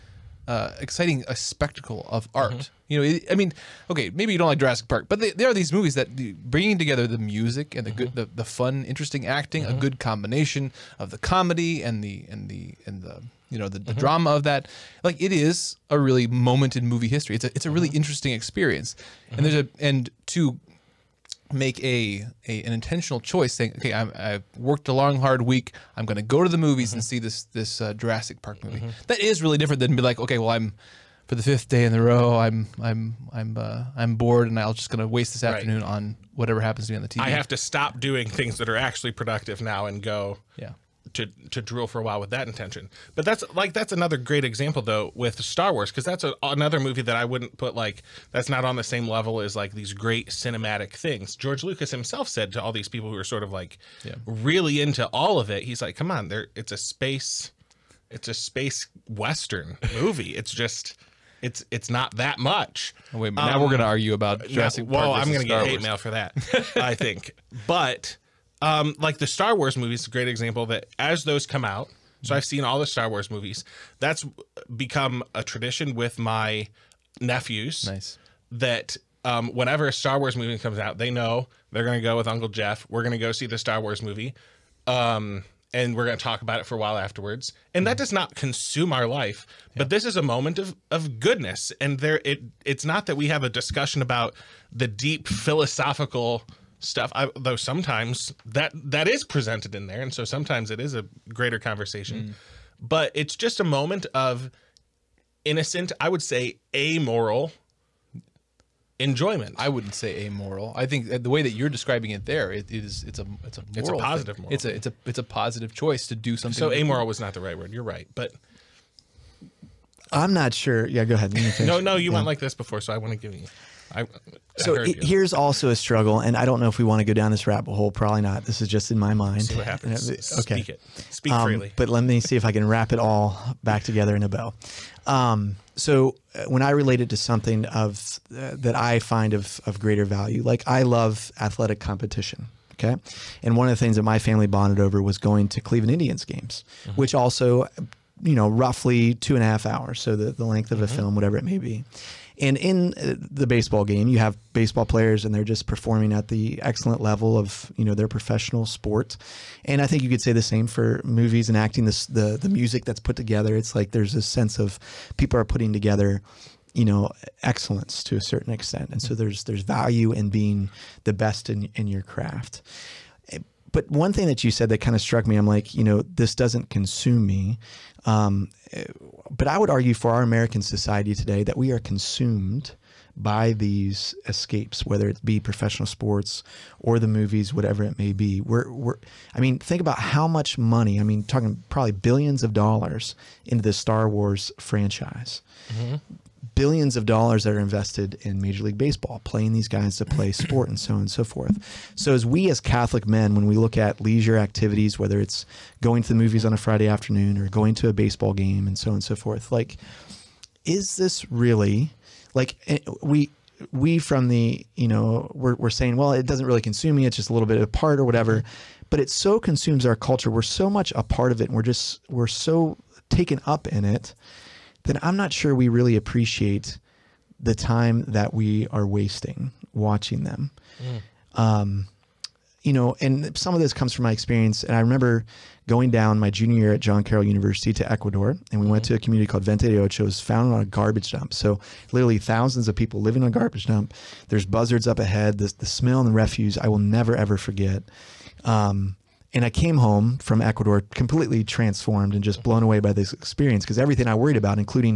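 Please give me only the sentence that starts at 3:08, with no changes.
We're, we're, I mean, think about how much money, I mean, talking probably billions of dollars into the Star Wars franchise.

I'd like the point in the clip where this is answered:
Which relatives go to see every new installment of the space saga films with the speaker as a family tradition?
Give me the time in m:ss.
1:16.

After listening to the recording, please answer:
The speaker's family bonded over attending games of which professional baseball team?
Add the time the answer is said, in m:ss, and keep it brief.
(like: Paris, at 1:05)
Cleveland Indians, at 2:25.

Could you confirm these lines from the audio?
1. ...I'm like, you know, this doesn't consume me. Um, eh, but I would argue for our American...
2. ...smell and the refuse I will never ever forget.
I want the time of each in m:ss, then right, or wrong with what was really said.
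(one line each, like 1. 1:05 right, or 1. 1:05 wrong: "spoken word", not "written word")
1. 2:55 right
2. 4:05 right.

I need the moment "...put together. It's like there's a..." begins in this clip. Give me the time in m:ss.
2:42.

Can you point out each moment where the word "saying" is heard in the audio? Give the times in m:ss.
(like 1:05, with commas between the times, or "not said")
0:23, 3:35.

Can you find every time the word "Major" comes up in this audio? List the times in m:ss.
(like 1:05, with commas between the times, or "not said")
3:18.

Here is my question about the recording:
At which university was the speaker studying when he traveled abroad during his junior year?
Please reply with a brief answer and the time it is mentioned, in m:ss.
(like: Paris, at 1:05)
John Carroll University, at 3:56.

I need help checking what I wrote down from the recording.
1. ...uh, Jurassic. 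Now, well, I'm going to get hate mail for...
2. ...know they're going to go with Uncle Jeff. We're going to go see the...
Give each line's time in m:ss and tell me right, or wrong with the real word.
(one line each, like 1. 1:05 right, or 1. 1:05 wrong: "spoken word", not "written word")
1. 1:04 right
2. 1:21 right.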